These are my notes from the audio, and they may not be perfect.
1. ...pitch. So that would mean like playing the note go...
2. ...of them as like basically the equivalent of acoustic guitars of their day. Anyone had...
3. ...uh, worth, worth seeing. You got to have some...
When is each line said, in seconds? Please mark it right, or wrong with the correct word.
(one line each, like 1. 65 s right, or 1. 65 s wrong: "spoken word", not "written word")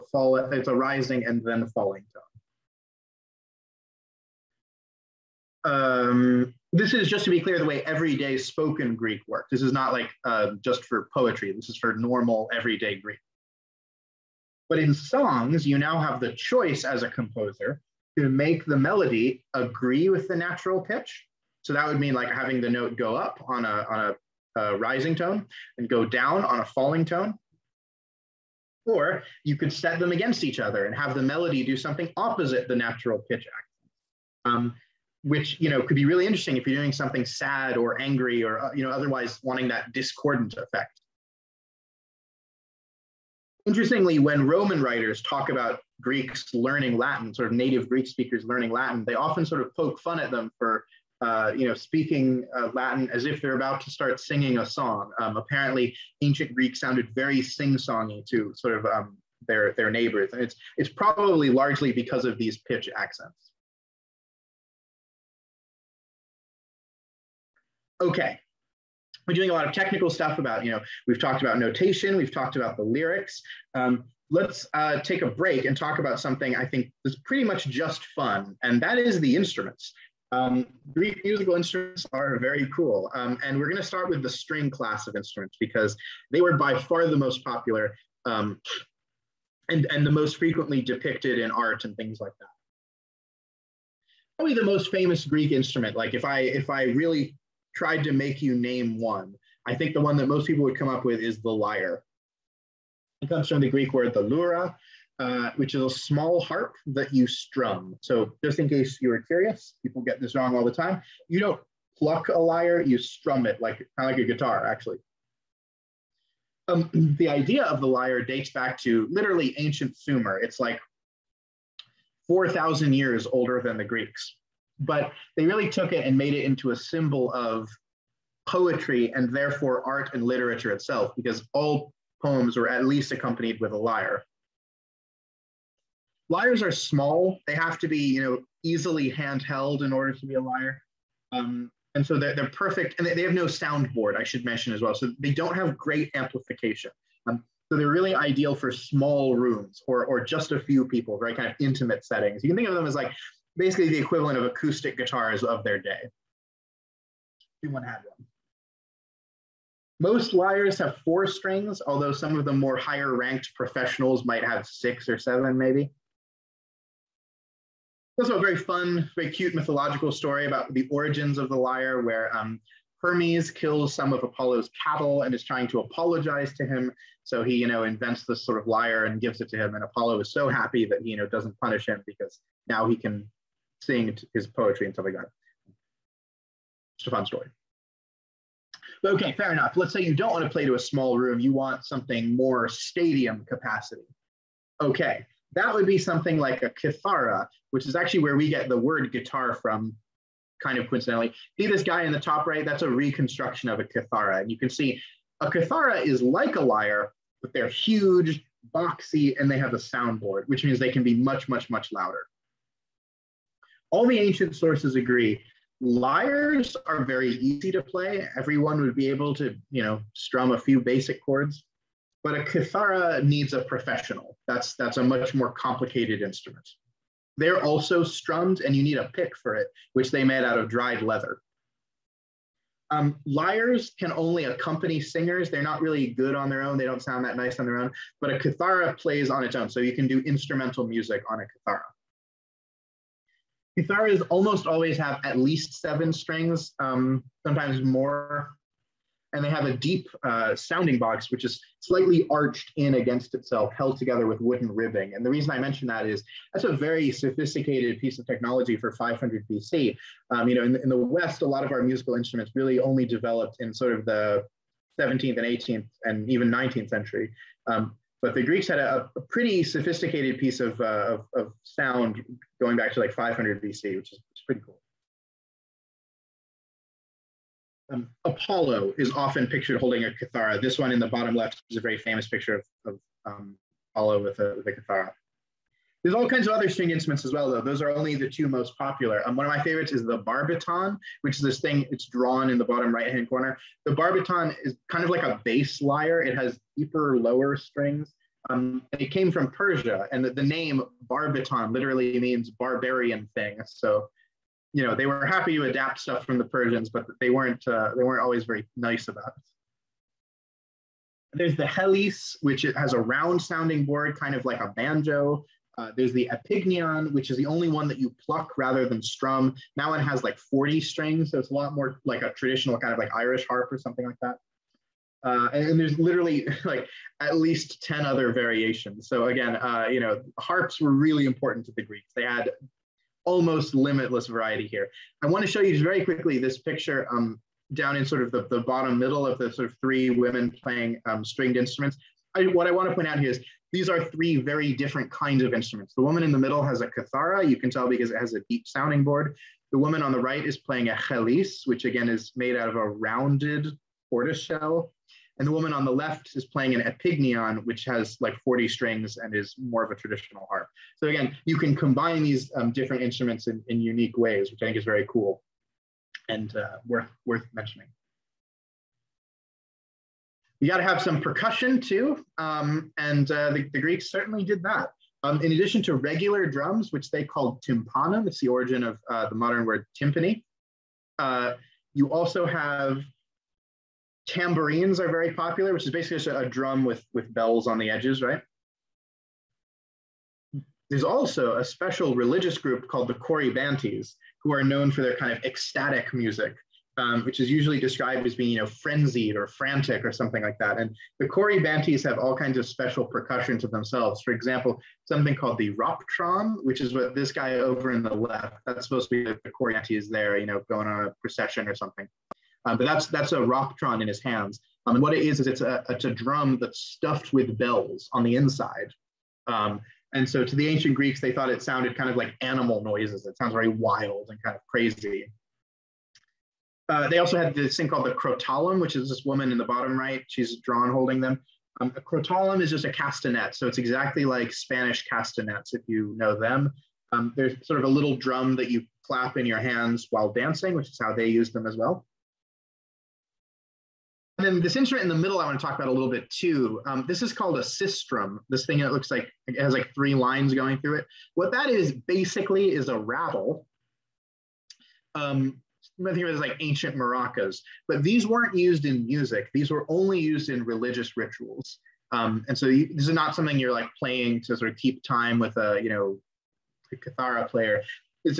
1. 20 s wrong: "having", not "playing"
2. 152 s right
3. 366 s wrong: "mentioning", not "seeing".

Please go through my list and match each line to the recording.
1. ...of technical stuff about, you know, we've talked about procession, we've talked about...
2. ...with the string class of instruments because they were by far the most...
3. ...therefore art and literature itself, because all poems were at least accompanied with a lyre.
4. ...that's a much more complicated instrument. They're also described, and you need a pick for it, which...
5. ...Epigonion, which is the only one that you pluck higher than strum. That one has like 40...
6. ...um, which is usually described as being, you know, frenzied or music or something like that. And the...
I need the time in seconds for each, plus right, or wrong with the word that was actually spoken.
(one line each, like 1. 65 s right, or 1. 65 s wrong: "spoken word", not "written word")
1. 69 s wrong: "notation", not "procession"
2. 84 s right
3. 129 s right
4. 224 s wrong: "strummed", not "described"
5. 316 s wrong: "rather", not "higher"
6. 396 s wrong: "frantic", not "music".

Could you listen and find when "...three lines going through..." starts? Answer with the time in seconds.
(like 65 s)
449 s.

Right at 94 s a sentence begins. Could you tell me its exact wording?
Probably the most famous Greek instrument, like if I, if I really tried to make you name one.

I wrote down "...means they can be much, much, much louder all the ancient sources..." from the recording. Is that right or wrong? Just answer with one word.
right.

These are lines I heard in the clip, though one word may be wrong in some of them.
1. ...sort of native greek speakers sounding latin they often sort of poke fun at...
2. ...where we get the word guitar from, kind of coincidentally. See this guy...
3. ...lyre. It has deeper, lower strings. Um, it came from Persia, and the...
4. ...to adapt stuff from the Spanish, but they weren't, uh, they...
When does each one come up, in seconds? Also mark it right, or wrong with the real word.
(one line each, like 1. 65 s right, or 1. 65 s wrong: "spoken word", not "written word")
1. 47 s wrong: "learning", not "sounding"
2. 198 s right
3. 295 s right
4. 305 s wrong: "Persians", not "Spanish".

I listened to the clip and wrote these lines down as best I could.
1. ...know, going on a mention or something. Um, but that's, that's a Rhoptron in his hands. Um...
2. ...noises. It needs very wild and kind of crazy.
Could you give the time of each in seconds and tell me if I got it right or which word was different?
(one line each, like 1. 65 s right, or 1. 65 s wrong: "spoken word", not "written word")
1. 410 s wrong: "procession", not "mention"
2. 422 s wrong: "sounds", not "needs".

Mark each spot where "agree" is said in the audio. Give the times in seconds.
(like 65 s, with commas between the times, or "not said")
19 s, 214 s.